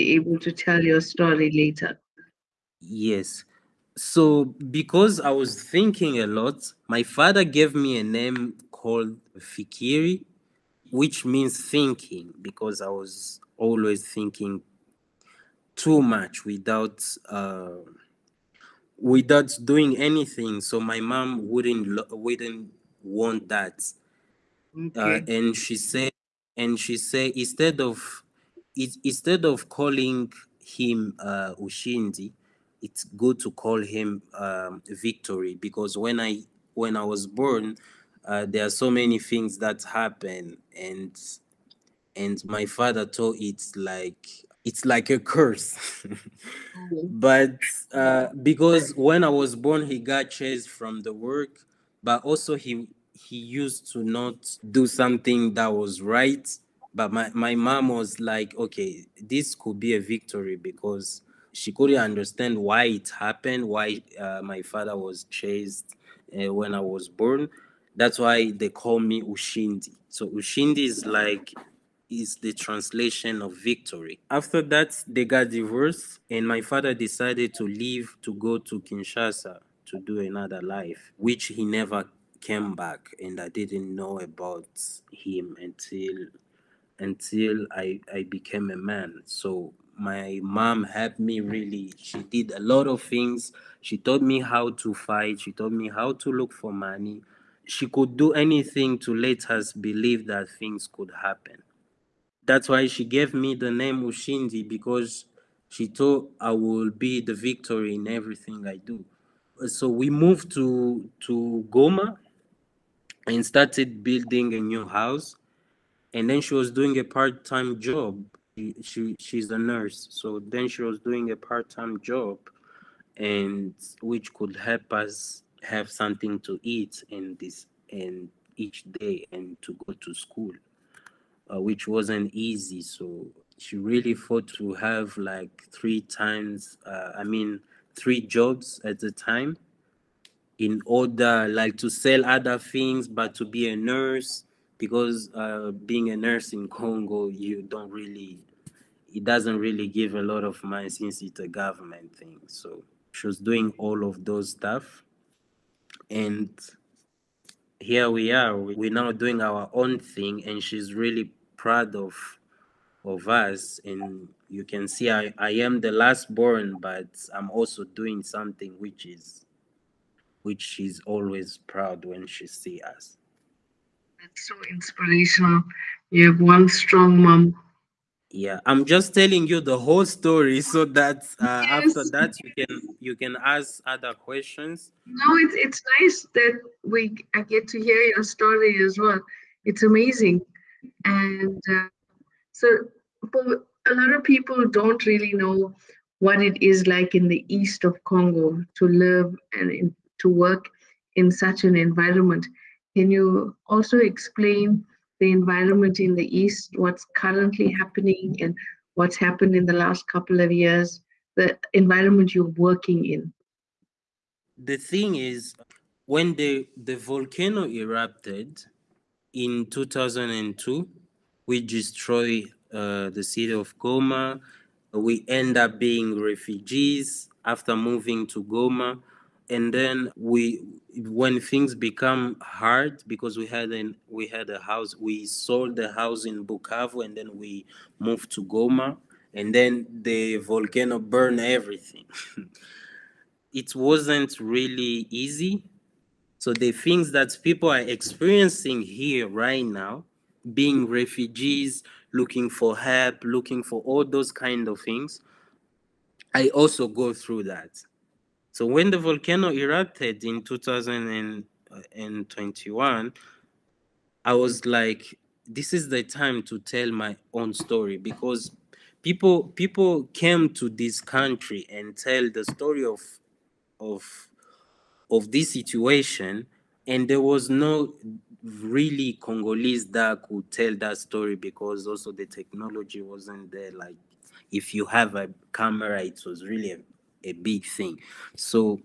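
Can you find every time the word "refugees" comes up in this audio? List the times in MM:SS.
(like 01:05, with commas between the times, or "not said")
03:46, 04:10.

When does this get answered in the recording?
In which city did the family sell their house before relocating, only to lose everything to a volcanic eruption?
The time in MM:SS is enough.
03:56.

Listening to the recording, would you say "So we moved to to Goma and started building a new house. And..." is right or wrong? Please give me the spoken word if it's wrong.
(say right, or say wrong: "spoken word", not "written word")
right.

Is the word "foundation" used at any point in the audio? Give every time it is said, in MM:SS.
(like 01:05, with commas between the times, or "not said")
not said.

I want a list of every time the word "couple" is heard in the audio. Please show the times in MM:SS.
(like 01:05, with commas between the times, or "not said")
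03:30.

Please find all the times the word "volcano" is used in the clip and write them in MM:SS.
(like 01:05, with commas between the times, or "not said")
03:36, 04:00, 04:18.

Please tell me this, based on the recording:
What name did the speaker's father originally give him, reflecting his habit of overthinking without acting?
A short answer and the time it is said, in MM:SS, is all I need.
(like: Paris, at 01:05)
Fikiri, at 00:09.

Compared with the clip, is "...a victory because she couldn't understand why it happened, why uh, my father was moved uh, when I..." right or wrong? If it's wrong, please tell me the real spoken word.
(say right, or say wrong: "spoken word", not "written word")
wrong: "chased", not "moved".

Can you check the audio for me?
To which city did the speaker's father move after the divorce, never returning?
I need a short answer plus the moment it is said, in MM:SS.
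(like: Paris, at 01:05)
Kinshasa, at 01:18.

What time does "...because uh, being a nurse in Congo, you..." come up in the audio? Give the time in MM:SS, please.
02:24.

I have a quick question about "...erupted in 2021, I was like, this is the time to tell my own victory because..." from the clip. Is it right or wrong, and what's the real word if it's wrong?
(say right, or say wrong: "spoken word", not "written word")
wrong: "story", not "victory".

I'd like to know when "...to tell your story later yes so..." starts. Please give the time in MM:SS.
00:00.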